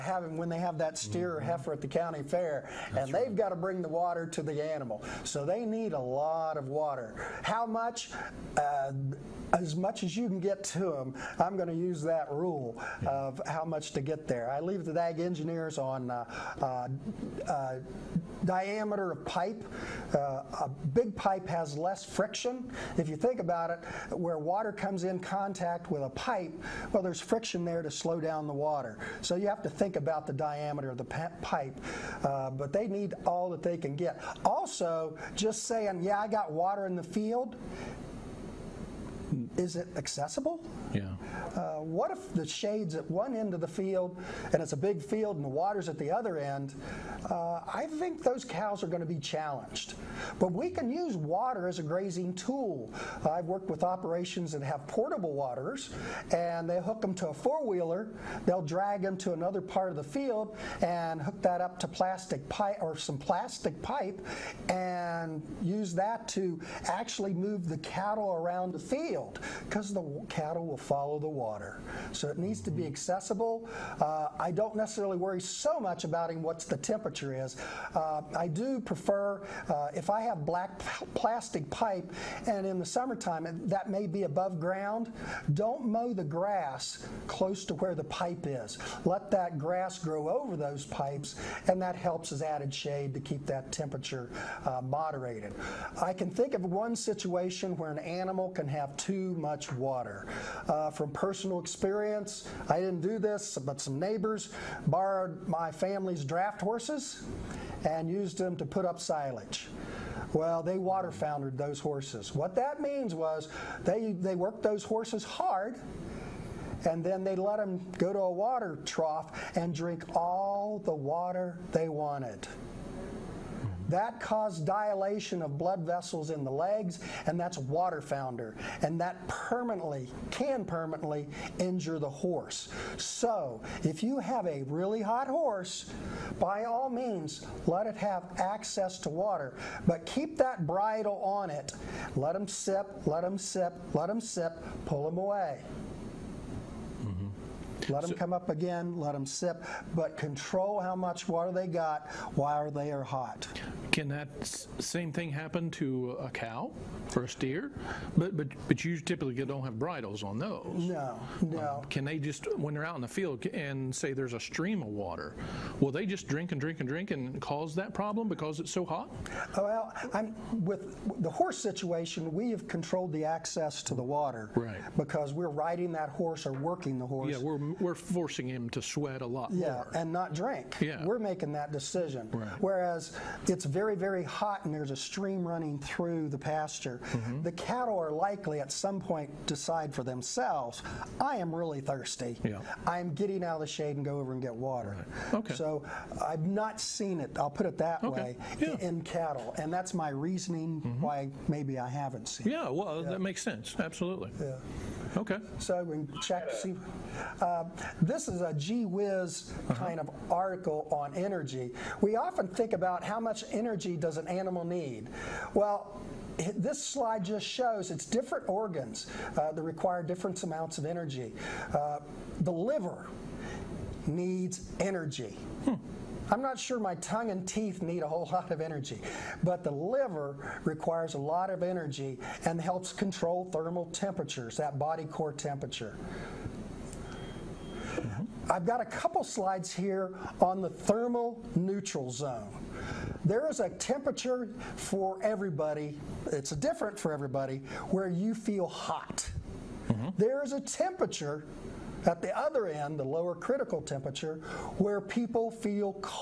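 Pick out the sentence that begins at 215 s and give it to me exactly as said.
Well, this slide just shows it's different organs uh, that require different amounts of energy.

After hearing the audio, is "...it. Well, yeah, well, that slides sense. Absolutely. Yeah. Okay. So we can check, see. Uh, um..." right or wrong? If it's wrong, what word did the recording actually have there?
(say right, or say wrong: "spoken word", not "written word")
wrong: "makes", not "slides".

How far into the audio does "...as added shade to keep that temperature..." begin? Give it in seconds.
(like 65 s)
92 s.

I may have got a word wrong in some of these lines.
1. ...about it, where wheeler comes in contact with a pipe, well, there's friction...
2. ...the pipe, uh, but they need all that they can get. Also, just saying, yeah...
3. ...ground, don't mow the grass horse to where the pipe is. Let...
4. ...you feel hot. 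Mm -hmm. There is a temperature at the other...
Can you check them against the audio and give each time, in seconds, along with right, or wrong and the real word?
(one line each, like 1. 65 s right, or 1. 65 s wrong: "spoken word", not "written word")
1. 23 s wrong: "water", not "wheeler"
2. 30 s right
3. 84 s wrong: "close", not "horse"
4. 248 s right.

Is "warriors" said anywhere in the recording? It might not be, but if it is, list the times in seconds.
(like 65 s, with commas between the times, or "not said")
not said.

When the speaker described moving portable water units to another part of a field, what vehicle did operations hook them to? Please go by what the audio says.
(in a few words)
four wheeler.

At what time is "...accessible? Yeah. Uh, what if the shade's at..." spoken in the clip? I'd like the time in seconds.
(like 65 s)
39 s.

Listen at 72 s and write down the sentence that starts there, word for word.
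So it needs to be mm-hmm.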